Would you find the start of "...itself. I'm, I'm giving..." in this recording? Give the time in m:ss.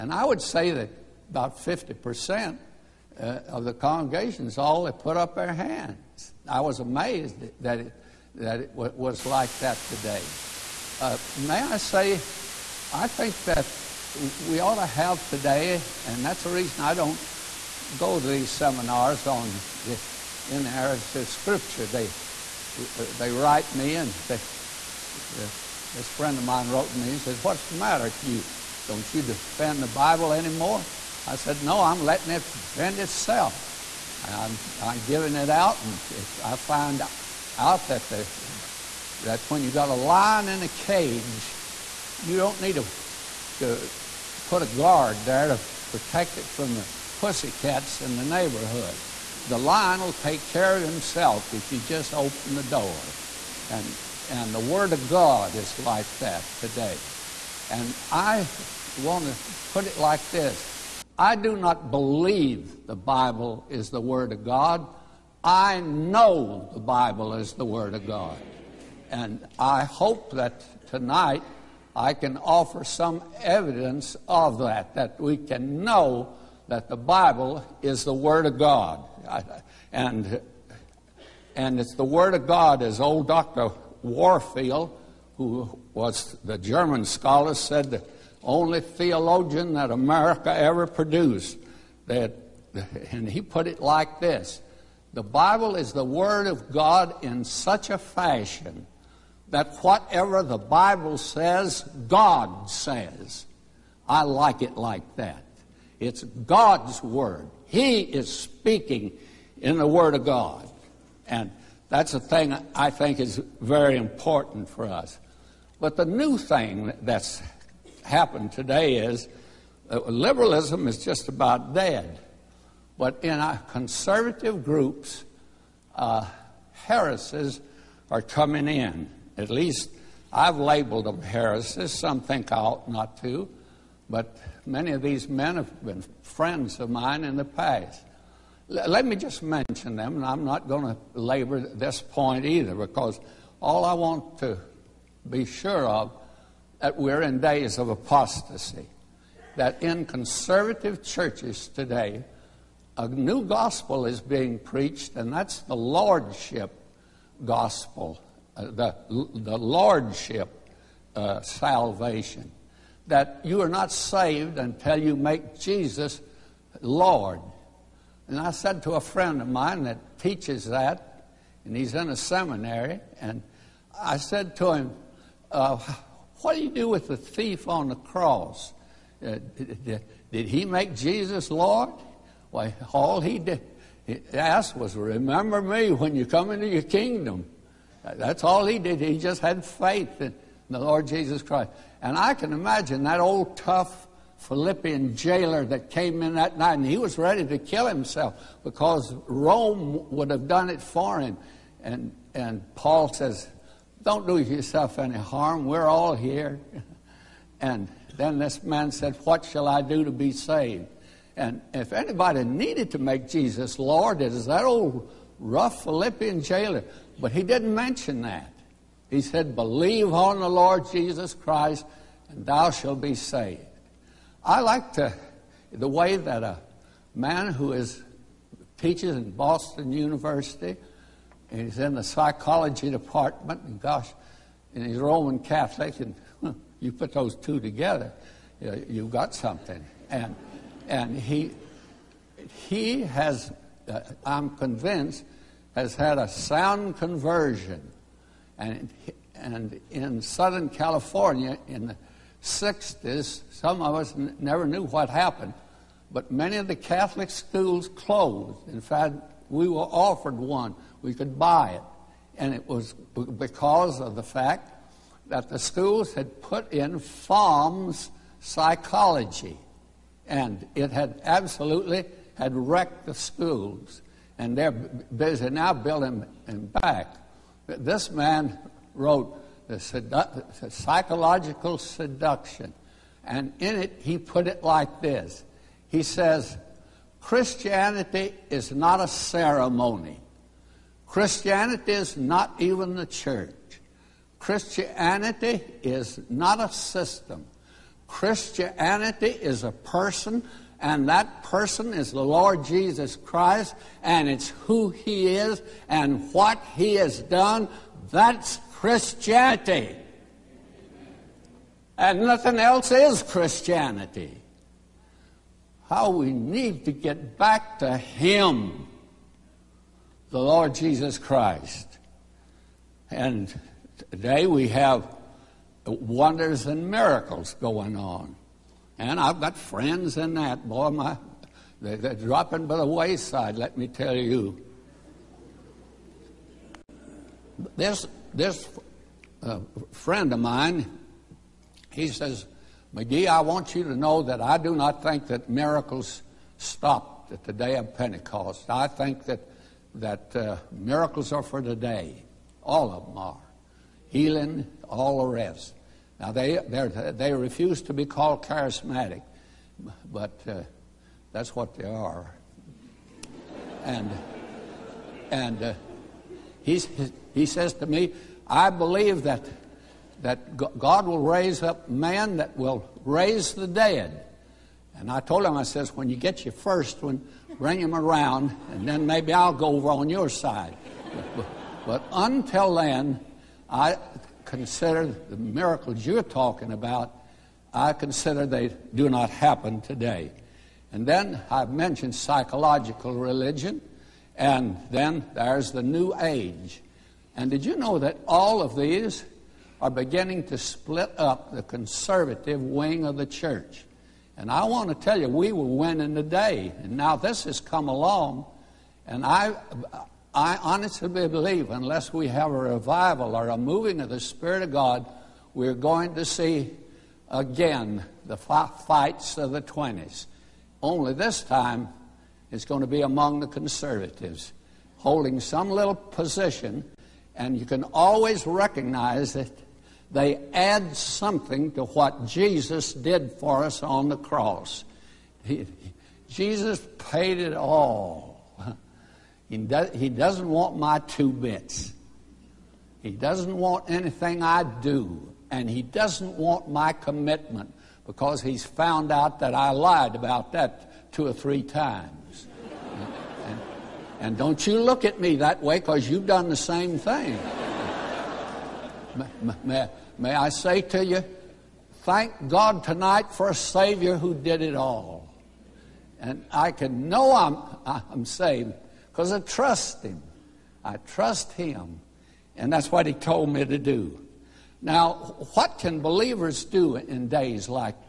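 0:32.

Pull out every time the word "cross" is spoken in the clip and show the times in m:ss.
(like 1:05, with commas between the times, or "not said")
2:57, 7:14.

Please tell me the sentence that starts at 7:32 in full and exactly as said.
and, and, and don't you look at me that way because you've done the same thing.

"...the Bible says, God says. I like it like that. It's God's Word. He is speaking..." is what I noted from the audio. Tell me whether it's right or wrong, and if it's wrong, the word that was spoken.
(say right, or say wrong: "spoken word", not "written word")
right.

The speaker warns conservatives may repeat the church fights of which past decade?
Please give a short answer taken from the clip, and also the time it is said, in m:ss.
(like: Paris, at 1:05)
the 20s, at 6:59.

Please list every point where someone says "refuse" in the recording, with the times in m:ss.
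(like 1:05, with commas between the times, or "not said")
5:57.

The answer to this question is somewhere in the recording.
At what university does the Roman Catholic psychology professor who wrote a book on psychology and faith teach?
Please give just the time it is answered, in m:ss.
3:49.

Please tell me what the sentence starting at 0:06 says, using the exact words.
I was amazed that it, that it was like that today.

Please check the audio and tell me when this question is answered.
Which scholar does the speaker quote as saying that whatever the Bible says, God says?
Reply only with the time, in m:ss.
1:23.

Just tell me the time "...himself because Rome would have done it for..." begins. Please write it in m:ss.
3:17.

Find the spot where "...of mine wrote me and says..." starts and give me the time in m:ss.
0:26.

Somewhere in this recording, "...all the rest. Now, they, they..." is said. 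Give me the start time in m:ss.
5:54.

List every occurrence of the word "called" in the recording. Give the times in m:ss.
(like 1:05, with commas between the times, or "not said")
5:58.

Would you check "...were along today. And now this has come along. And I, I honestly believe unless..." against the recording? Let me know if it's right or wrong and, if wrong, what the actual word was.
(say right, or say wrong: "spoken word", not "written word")
wrong: "winning", not "along".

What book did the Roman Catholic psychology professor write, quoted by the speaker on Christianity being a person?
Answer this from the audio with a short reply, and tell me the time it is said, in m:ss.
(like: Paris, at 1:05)
Psychological Seduction, at 4:40.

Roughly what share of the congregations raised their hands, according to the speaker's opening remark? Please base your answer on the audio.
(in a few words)
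50%.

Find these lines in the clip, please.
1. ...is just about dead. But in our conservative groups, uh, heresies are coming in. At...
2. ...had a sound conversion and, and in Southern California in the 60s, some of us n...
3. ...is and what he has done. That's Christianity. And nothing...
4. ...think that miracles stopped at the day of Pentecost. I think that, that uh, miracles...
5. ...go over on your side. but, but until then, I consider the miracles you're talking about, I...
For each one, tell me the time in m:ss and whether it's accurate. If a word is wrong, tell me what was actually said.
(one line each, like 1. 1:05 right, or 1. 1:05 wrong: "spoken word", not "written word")
1. 2:00 right
2. 4:05 right
3. 5:05 right
4. 5:45 right
5. 6:19 right.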